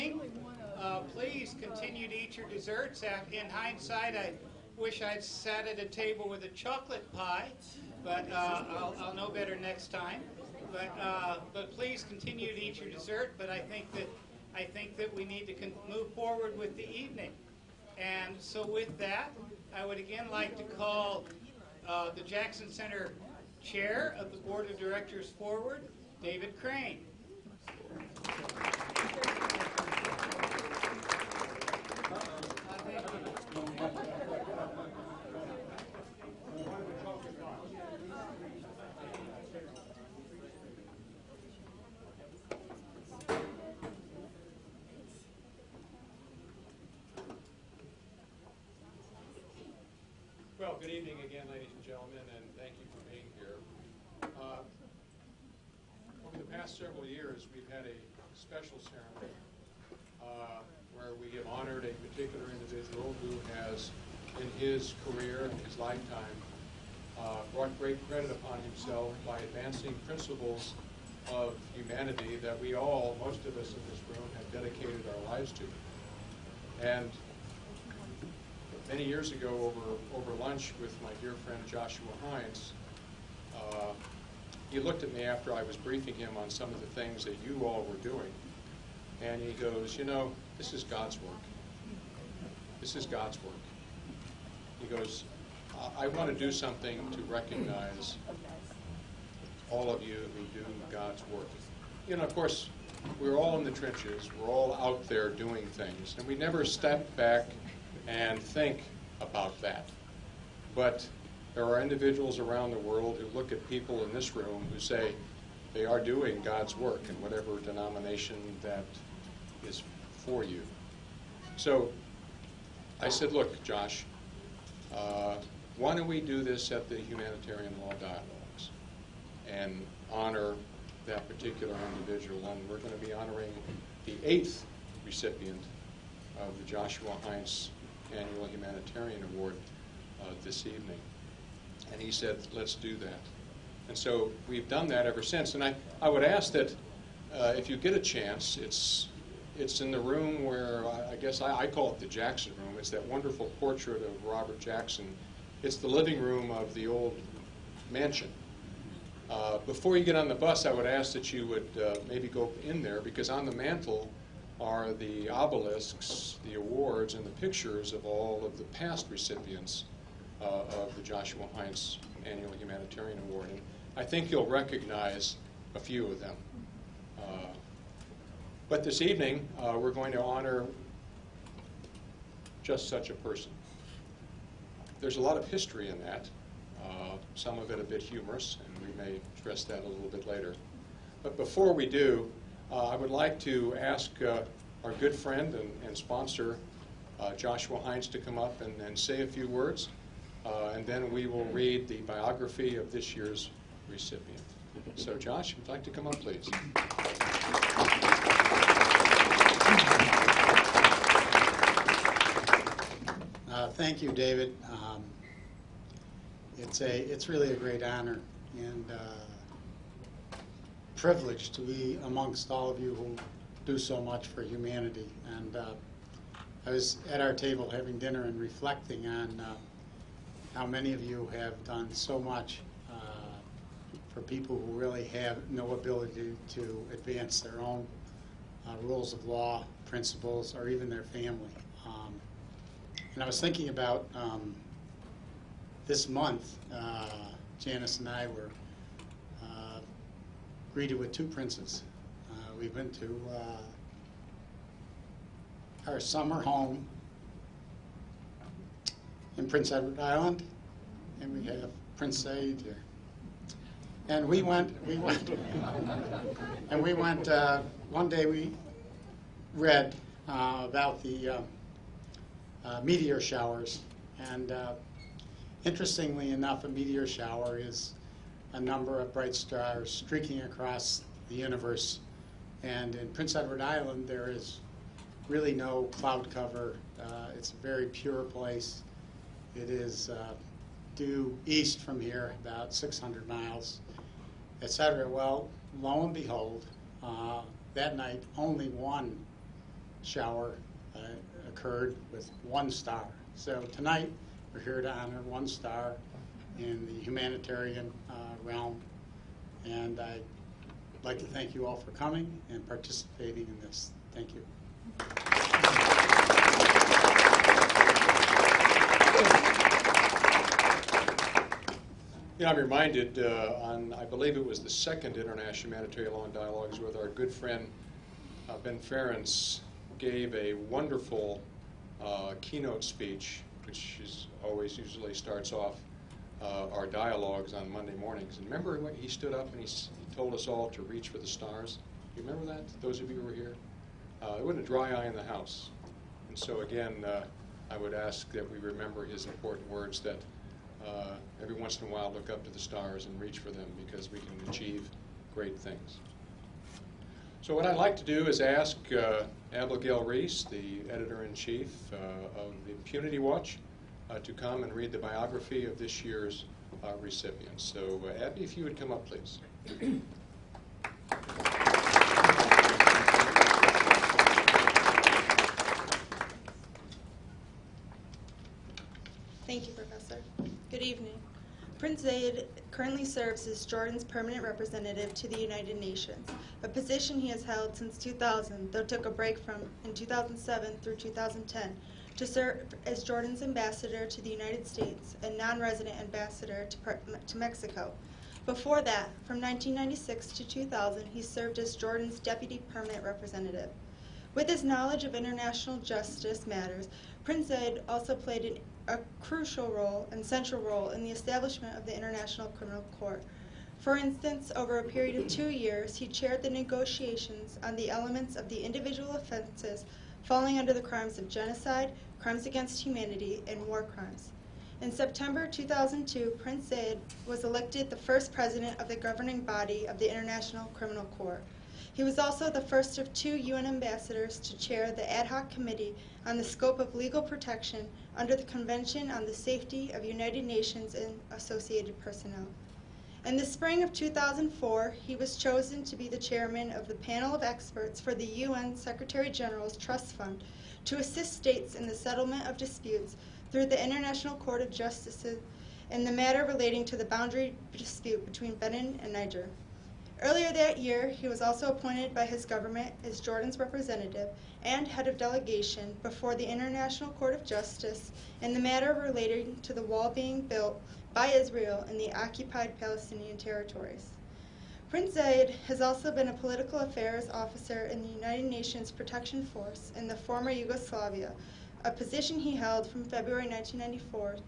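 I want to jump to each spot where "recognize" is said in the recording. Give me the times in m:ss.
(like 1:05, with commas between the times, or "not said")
1:37, 2:54.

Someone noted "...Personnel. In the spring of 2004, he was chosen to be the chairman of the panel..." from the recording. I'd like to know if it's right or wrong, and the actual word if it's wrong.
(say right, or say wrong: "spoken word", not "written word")
right.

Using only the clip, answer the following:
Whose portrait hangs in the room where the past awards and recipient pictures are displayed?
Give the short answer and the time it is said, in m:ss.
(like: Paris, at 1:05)
Robert Jackson, at 2:34.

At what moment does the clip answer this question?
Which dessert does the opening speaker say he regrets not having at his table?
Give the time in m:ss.
0:06.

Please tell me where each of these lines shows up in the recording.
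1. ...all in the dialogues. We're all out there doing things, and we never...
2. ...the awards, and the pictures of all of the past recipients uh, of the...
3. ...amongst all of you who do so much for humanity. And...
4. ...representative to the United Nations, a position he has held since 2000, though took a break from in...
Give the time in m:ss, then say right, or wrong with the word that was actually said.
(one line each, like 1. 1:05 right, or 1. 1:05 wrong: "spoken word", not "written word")
1. 1:43 wrong: "trenches", not "dialogues"
2. 2:46 right
3. 3:42 right
4. 6:24 right.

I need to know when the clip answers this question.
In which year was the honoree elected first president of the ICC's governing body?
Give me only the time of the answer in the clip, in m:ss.
7:05.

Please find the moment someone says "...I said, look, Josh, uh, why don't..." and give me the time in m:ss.
2:02.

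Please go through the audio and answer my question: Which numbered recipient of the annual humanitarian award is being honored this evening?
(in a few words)
Eighth.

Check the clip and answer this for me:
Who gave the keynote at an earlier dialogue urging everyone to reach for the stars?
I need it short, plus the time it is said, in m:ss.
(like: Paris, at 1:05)
Ben Ferencz, at 5:28.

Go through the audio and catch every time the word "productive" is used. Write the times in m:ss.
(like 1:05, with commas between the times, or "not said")
not said.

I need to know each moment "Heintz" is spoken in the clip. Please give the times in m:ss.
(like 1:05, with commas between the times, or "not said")
1:22, 2:17, 2:51, 3:17.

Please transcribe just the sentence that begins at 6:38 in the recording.
Before that, from 1996 to 2000, he served as Jordan's deputy permanent representative.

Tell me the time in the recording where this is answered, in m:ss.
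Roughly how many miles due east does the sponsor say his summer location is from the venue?
4:52.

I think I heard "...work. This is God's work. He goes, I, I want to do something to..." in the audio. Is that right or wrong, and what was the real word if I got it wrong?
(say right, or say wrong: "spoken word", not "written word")
right.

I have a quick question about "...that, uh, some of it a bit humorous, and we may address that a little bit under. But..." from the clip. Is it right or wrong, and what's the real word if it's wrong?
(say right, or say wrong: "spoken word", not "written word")
wrong: "later", not "under".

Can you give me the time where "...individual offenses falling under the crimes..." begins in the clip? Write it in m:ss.
6:58.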